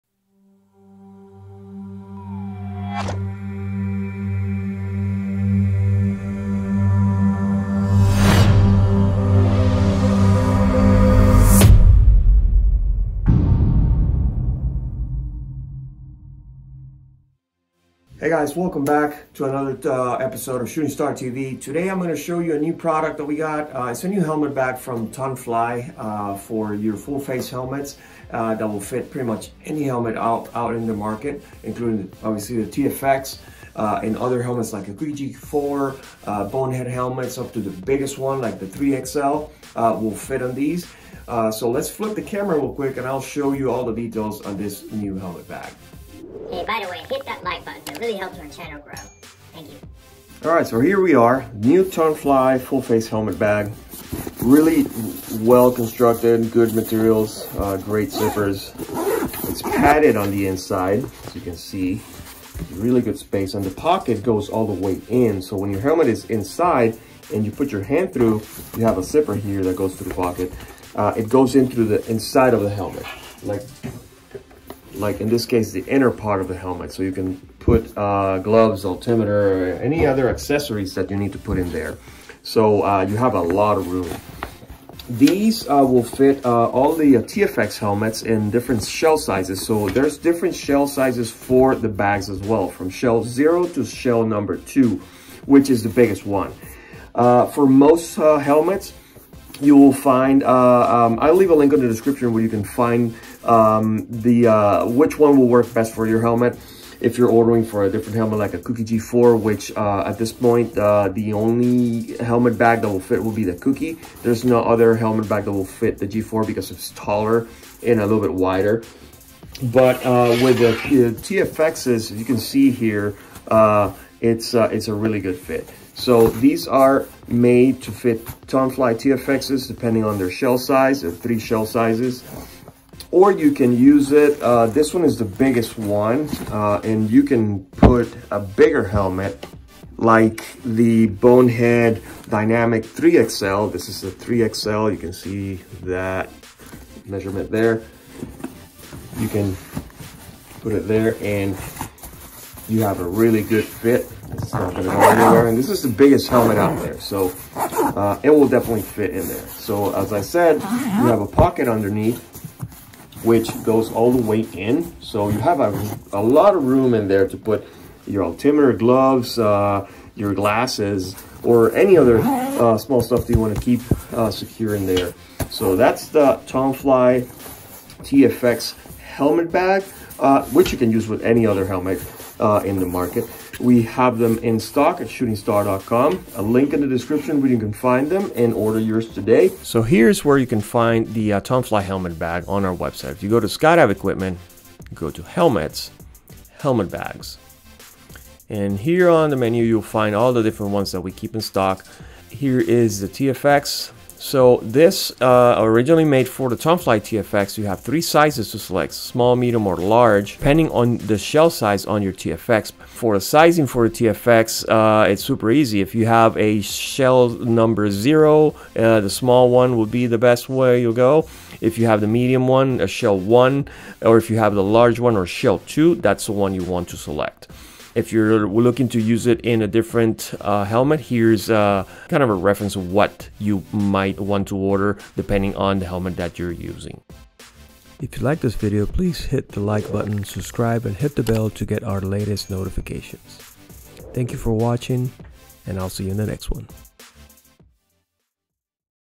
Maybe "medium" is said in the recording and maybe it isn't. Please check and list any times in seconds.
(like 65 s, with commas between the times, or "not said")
209 s, 222 s.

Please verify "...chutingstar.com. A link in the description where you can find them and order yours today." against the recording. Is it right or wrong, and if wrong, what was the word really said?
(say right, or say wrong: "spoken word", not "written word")
right.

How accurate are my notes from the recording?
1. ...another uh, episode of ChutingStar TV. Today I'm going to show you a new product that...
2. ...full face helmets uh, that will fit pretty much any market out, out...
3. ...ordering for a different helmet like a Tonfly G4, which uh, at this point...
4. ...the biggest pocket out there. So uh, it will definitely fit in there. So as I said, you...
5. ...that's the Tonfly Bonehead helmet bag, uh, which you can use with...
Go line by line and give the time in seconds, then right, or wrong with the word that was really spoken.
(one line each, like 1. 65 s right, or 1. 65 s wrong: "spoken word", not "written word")
1. 19 s right
2. 26 s wrong: "helmet", not "market"
3. 107 s wrong: "Cookie", not "Tonfly"
4. 155 s wrong: "helmet", not "pocket"
5. 175 s wrong: "TFX", not "Bonehead".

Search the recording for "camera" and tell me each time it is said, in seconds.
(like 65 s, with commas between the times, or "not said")
42 s.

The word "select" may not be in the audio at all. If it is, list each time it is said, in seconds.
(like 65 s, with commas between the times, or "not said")
208 s, 226 s.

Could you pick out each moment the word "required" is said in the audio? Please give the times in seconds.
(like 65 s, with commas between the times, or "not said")
not said.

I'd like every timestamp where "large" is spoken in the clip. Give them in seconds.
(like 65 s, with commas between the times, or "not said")
209 s, 224 s.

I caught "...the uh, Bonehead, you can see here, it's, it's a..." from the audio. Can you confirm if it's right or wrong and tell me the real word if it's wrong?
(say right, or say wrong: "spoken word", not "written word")
wrong: "TFXs", not "Bonehead".